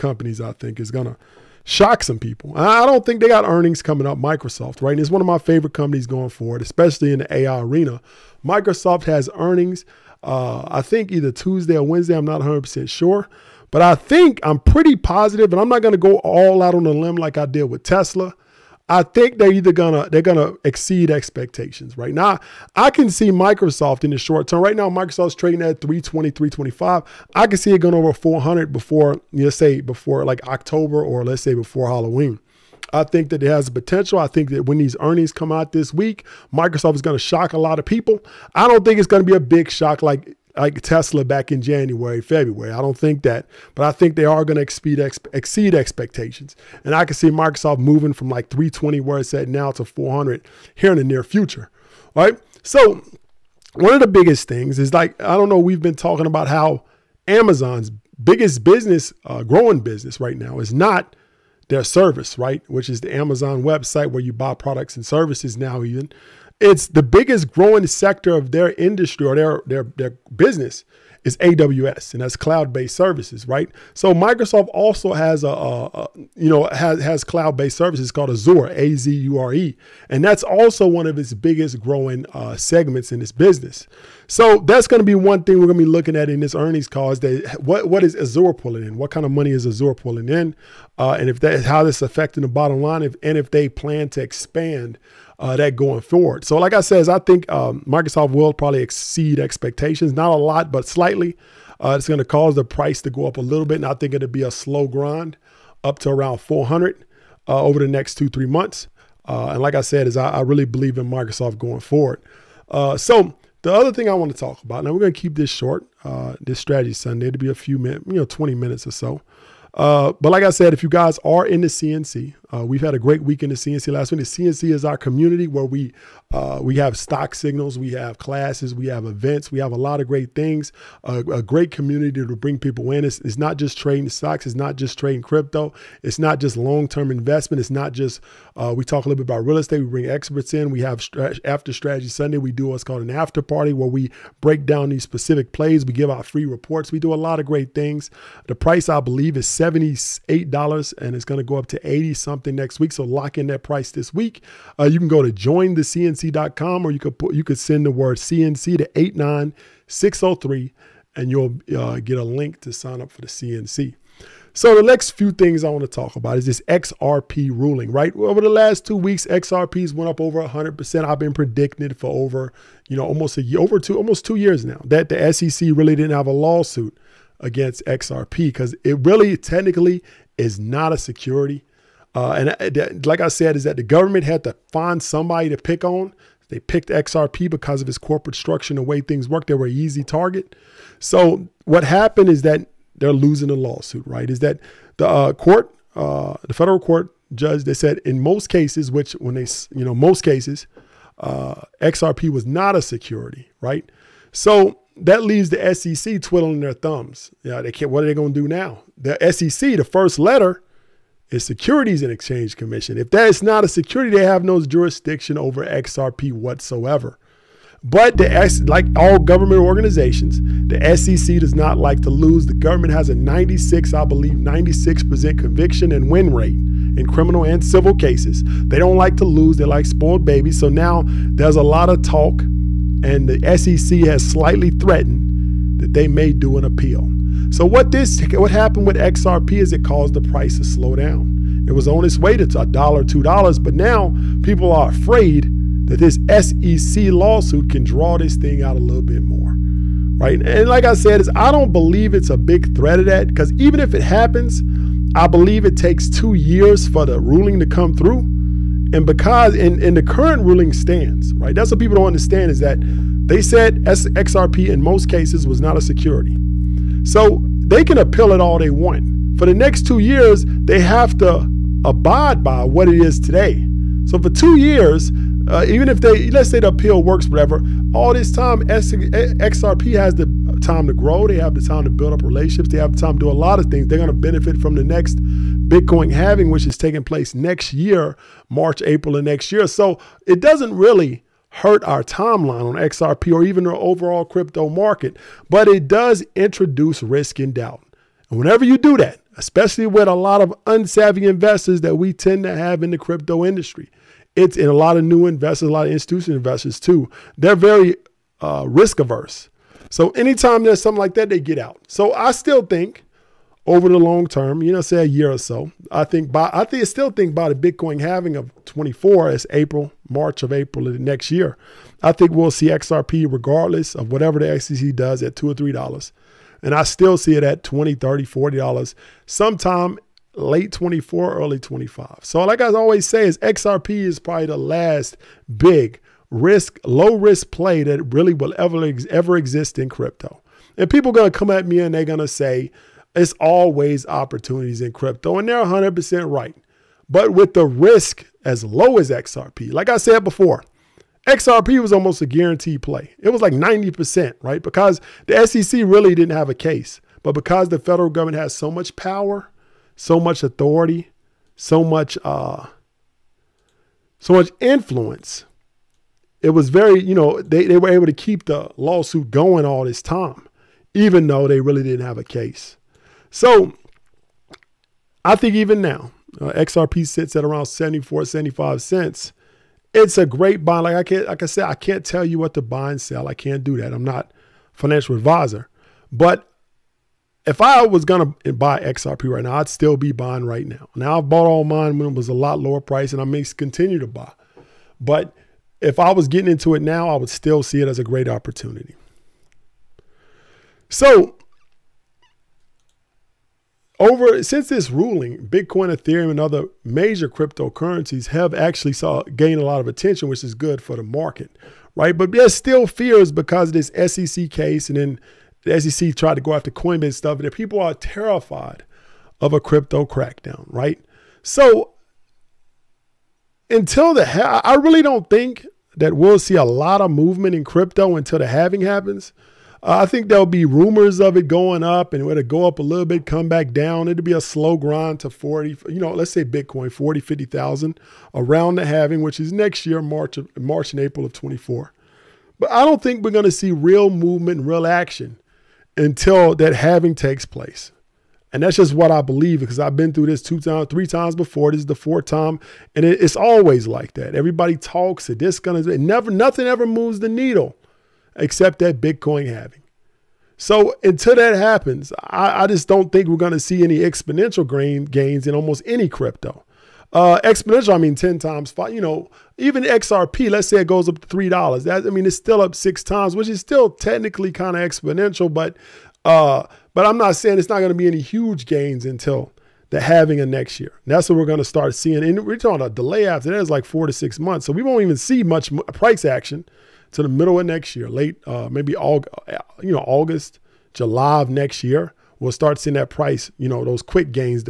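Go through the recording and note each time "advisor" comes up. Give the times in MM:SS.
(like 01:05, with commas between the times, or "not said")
06:25.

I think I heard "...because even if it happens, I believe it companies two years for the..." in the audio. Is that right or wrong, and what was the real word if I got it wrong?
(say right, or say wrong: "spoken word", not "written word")
wrong: "takes", not "companies".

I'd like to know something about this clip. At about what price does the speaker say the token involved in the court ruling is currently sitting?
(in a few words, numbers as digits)
74-75 cents.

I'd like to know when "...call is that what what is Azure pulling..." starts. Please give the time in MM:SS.
01:26.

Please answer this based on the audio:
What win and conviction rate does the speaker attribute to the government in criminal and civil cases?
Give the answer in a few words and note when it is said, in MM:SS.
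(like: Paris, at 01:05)
96%, at 03:44.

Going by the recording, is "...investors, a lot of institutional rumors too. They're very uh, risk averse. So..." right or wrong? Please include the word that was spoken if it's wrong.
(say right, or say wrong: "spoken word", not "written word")
wrong: "investors", not "rumors".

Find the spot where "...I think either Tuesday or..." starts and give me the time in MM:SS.
00:10.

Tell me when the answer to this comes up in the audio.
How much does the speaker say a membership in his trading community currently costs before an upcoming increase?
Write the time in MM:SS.
02:29.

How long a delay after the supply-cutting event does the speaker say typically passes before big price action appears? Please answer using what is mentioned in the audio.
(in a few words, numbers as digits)
4 to 6 months.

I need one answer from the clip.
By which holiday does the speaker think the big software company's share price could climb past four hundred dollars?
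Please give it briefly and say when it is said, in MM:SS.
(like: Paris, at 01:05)
Halloween, at 00:31.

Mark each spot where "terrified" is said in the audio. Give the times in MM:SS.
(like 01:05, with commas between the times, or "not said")
06:57.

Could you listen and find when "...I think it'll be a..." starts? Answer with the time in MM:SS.
01:43.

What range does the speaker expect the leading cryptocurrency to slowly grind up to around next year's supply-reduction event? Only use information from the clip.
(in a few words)
40,000-50,000.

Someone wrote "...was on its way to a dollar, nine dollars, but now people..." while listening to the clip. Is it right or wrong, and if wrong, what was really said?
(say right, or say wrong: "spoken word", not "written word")
wrong: "two", not "nine".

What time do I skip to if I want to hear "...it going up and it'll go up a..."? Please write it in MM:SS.
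07:11.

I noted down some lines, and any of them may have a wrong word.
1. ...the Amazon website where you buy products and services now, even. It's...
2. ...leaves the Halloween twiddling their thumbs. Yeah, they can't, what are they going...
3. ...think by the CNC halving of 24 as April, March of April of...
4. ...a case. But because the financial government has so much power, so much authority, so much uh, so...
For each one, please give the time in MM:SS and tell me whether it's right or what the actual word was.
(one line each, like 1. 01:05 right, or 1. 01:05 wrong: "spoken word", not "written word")
1. 01:03 right
2. 03:25 wrong: "SEC", not "Halloween"
3. 05:17 wrong: "Bitcoin", not "CNC"
4. 05:56 wrong: "federal", not "financial".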